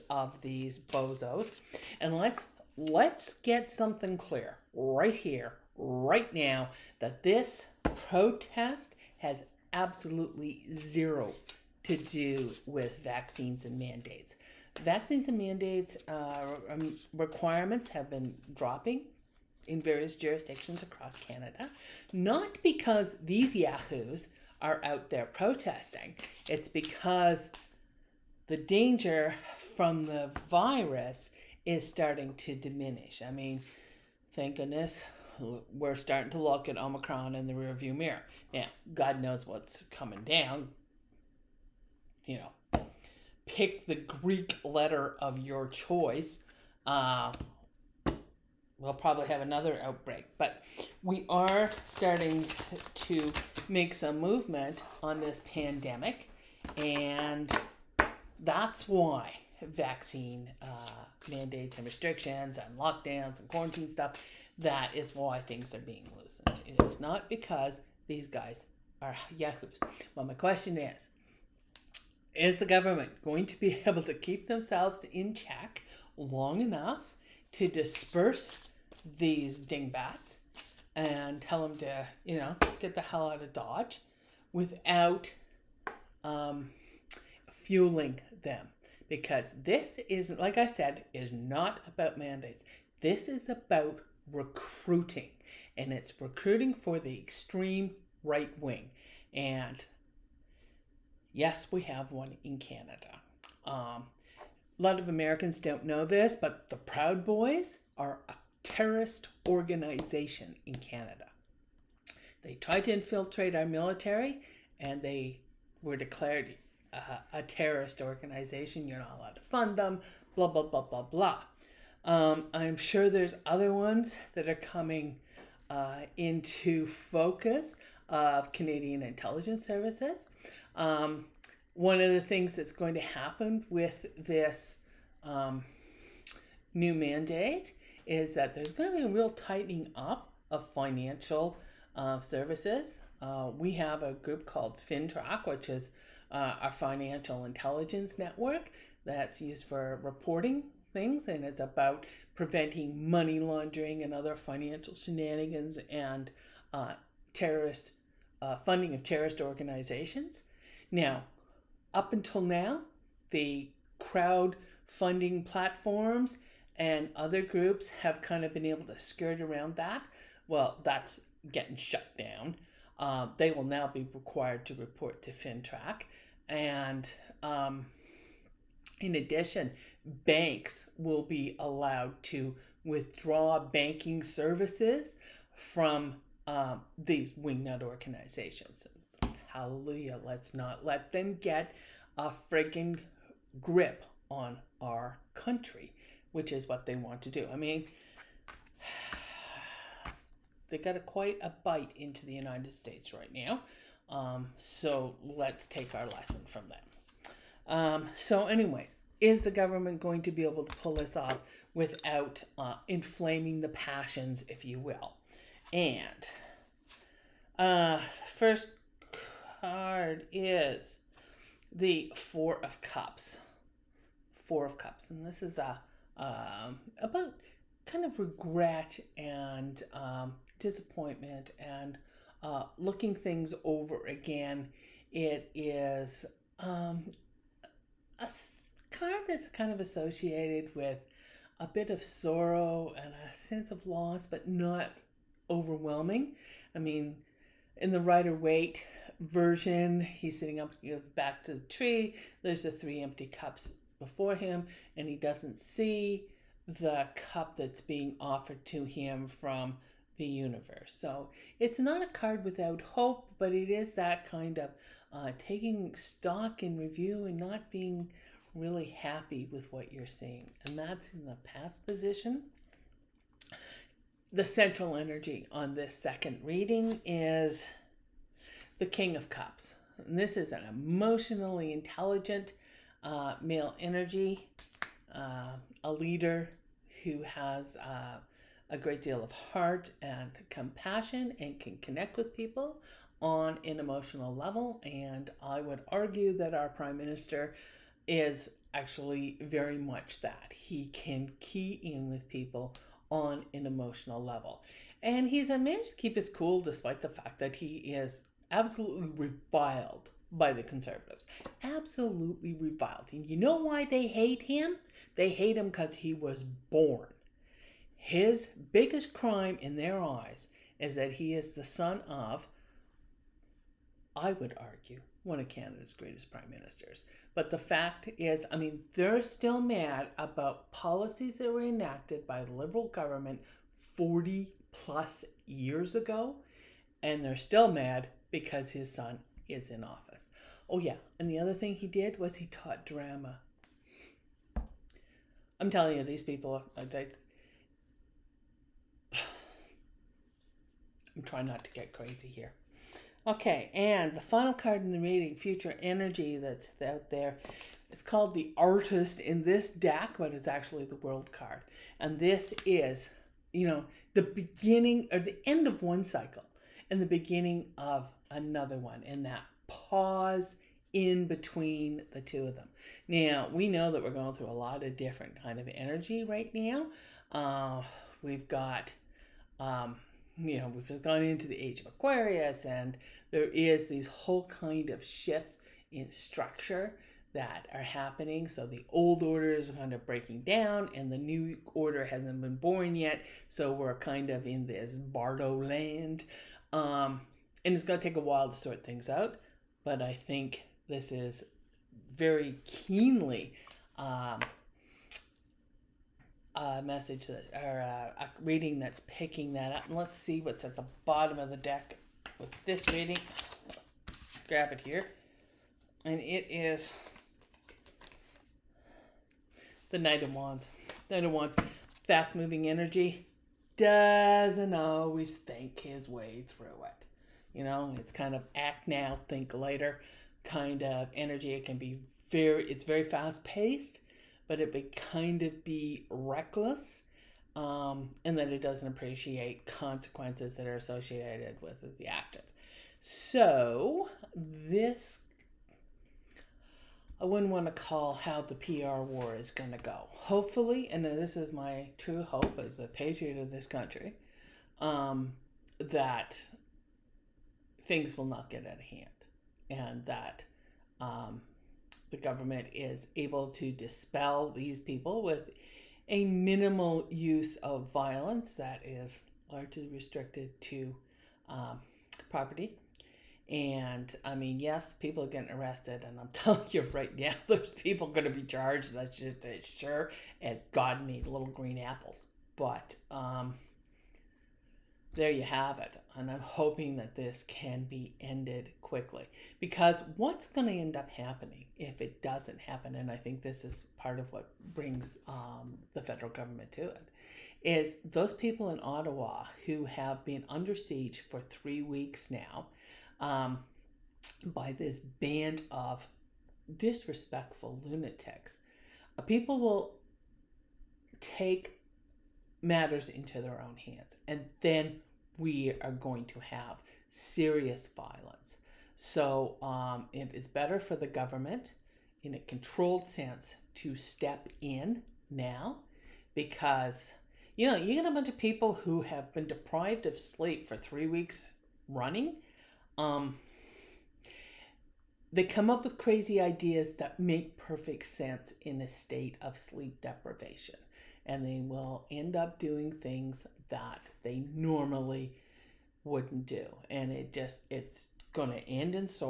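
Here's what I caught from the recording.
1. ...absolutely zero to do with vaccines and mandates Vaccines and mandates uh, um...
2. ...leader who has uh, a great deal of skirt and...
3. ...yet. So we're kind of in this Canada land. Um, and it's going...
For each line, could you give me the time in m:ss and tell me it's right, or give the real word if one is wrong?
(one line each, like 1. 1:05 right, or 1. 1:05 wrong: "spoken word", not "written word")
1. 0:09 right
2. 4:45 wrong: "heart", not "skirt"
3. 6:32 wrong: "Bardo", not "Canada".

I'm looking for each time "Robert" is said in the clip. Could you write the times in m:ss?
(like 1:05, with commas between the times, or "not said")
not said.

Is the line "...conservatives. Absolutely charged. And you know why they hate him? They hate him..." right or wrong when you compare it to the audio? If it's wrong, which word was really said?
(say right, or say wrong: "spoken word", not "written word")
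wrong: "reviled", not "charged".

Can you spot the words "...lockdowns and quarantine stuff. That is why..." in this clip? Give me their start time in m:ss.
1:02.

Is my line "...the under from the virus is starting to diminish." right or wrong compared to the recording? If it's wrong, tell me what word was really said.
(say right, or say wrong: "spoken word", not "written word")
wrong: "danger", not "under".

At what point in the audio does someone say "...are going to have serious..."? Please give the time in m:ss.
8:35.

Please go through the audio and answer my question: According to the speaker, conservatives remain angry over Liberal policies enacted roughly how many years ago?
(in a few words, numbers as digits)
40 plus years.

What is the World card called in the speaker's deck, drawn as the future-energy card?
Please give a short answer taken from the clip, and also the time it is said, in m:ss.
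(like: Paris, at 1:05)
the Artist, at 5:58.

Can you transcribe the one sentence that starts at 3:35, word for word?
And uh, first card is the Four of Cups.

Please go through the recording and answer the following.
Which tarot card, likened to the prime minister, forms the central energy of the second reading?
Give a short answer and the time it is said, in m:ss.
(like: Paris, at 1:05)
King of Cups, at 4:38.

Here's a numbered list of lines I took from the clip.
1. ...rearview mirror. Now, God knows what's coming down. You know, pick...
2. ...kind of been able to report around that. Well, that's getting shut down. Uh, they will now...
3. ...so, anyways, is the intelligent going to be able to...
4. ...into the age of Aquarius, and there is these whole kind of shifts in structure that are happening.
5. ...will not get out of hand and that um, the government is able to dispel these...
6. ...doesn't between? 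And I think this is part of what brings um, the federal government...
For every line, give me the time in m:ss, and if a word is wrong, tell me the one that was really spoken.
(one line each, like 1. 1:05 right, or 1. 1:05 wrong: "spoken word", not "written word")
1. 0:37 right
2. 2:48 wrong: "skirt", not "report"
3. 3:28 wrong: "government", not "intelligent"
4. 6:21 right
5. 7:38 right
6. 8:12 wrong: "happen", not "between".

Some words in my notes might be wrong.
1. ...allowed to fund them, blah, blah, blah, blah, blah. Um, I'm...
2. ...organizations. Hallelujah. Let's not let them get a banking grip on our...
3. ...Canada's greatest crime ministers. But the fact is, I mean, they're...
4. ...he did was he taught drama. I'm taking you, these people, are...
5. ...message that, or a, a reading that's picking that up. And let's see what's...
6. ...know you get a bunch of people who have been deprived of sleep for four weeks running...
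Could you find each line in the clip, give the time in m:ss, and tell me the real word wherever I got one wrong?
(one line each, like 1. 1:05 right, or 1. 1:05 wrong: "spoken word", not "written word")
1. 1:59 right
2. 3:07 wrong: "freaking", not "banking"
3. 5:25 wrong: "prime", not "crime"
4. 5:41 wrong: "telling", not "taking"
5. 6:46 right
6. 8:47 wrong: "three", not "four".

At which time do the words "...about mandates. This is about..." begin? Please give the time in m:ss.
1:31.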